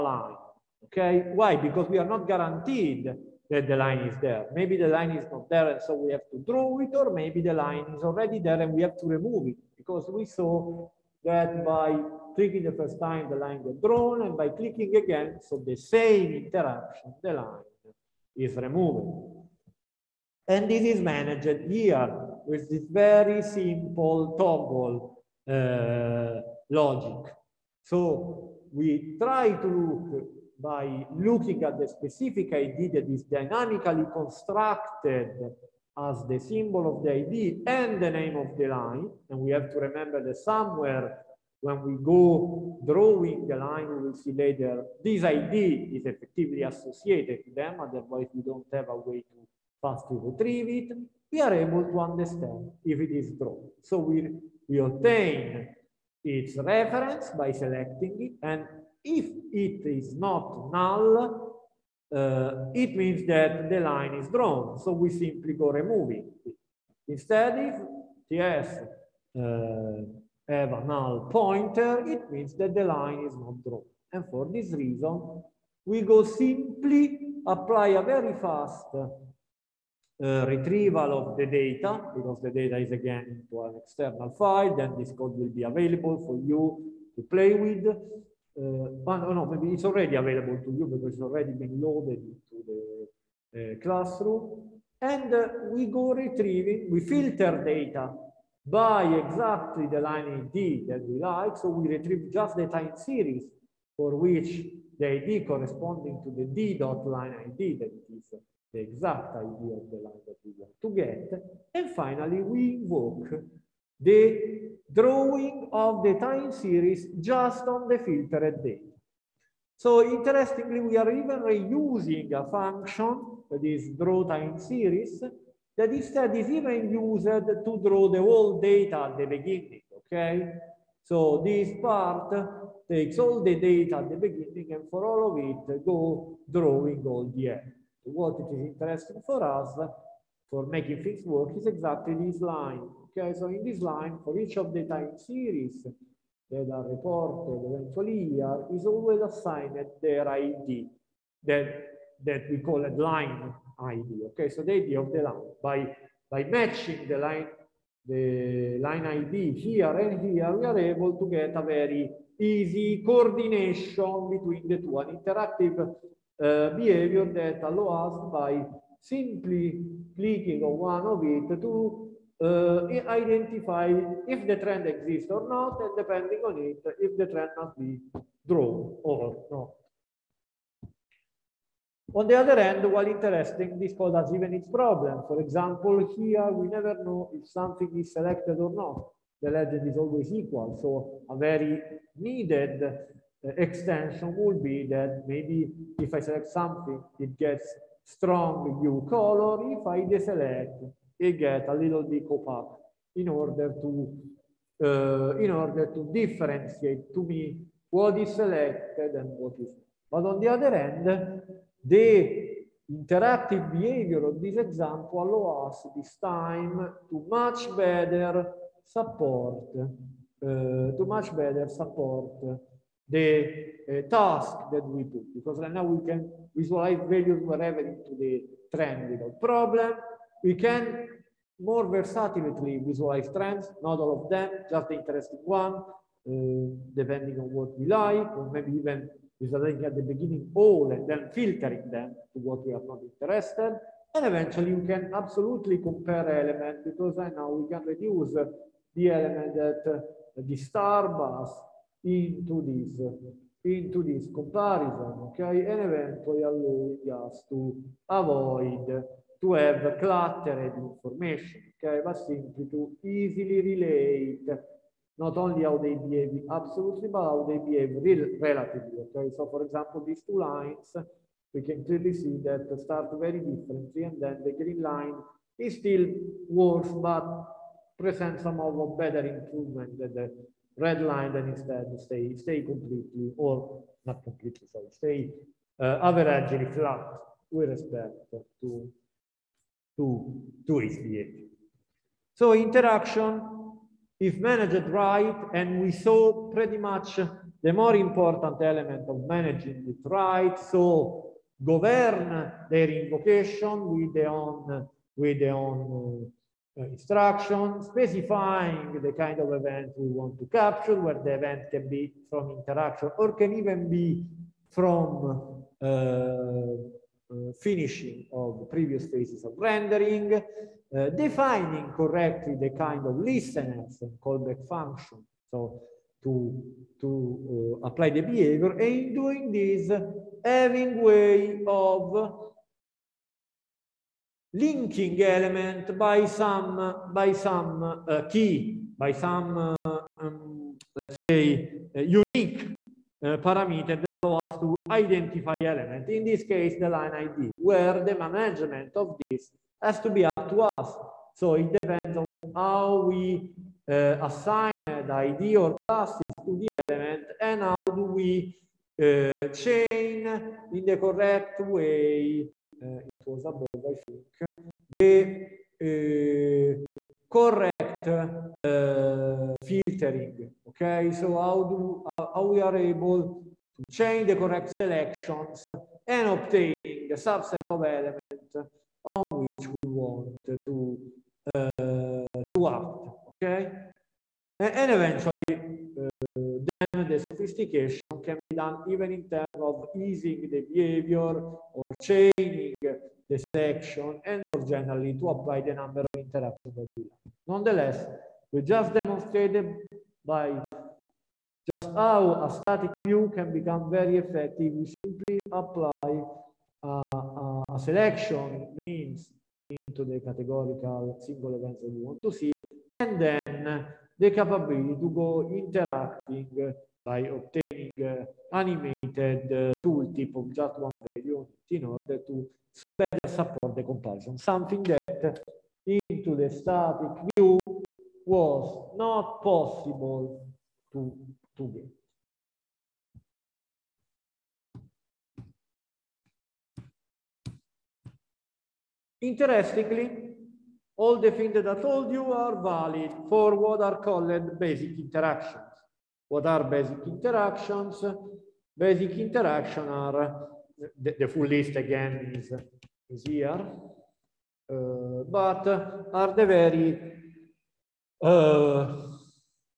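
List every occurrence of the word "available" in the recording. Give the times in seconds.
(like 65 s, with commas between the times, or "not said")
85 s, 90 s.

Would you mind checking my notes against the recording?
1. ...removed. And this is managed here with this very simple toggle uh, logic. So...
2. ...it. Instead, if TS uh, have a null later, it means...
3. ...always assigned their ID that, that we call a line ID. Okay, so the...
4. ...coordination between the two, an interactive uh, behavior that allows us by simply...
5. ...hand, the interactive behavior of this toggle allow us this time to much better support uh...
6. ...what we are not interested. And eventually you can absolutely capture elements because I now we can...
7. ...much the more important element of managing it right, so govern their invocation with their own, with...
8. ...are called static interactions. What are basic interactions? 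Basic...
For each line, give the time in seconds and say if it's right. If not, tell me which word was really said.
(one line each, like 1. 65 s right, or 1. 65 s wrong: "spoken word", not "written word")
1. 18 s right
2. 66 s wrong: "pointer", not "later"
3. 148 s right
4. 163 s right
5. 210 s wrong: "example", not "toggle"
6. 242 s wrong: "compare", not "capture"
7. 296 s right
8. 443 s wrong: "basic", not "static".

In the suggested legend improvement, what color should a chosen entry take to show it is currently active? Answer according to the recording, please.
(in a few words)
strong blue.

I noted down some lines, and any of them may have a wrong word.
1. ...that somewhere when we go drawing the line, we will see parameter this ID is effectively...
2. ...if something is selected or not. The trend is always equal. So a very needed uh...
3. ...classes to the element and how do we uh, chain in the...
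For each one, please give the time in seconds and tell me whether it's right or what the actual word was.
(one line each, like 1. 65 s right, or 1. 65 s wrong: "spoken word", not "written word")
1. 40 s wrong: "later", not "parameter"
2. 187 s wrong: "legend", not "trend"
3. 355 s right.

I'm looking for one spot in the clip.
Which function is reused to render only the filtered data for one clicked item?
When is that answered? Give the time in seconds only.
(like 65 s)
123 s.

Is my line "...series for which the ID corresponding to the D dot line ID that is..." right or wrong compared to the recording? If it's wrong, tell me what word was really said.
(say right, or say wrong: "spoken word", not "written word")
right.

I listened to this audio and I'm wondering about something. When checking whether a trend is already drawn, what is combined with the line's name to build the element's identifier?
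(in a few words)
The symbol of the ID.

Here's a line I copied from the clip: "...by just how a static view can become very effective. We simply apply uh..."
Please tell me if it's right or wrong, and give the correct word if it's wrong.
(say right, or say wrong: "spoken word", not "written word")
right.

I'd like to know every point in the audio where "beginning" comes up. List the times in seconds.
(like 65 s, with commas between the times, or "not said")
129 s, 134 s, 240 s.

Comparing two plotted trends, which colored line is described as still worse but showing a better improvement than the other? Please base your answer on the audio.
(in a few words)
green line.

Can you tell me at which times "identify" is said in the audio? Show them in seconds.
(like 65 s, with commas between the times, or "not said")
173 s, 344 s.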